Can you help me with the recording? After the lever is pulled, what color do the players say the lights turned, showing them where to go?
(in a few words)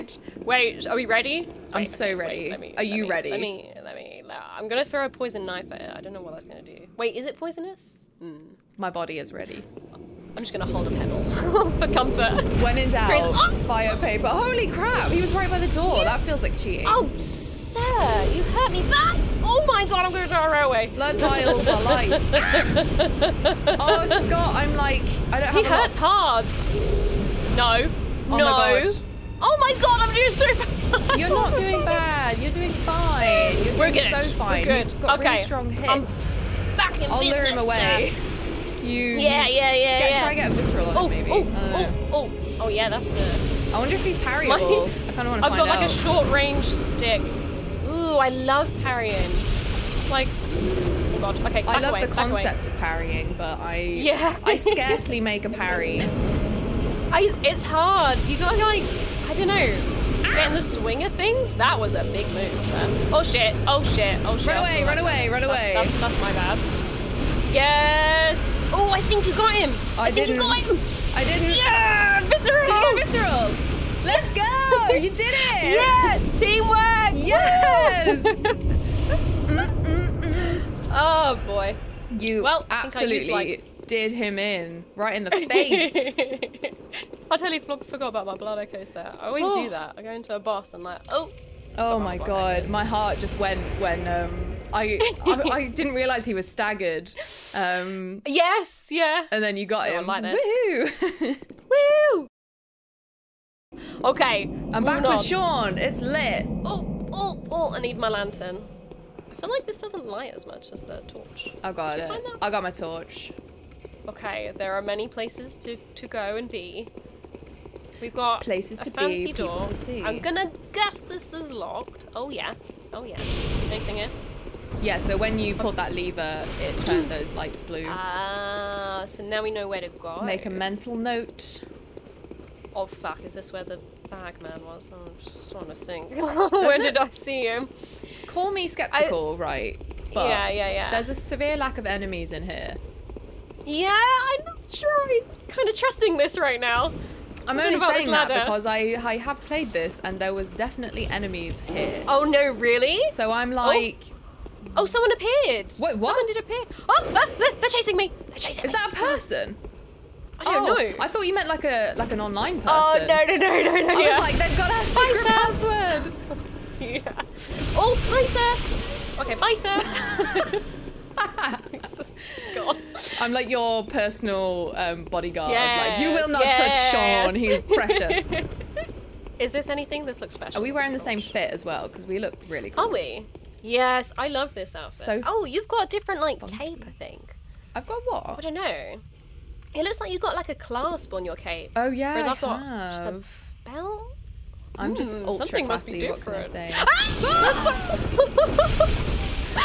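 blue.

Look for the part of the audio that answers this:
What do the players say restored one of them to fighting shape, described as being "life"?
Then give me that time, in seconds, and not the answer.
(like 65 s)
20 s.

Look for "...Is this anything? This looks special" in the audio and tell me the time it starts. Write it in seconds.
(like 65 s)
179 s.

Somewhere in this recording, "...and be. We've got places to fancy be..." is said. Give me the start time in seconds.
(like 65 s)
116 s.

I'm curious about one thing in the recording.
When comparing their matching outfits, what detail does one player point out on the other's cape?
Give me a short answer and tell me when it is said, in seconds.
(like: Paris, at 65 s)
a clasp, at 190 s.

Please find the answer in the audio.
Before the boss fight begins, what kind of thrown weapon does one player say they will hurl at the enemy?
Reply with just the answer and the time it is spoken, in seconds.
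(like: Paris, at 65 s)
poison knife, at 5 s.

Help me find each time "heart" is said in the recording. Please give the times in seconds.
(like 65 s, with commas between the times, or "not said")
92 s.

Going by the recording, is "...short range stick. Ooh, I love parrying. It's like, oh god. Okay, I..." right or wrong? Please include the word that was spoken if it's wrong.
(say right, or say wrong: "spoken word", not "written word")
right.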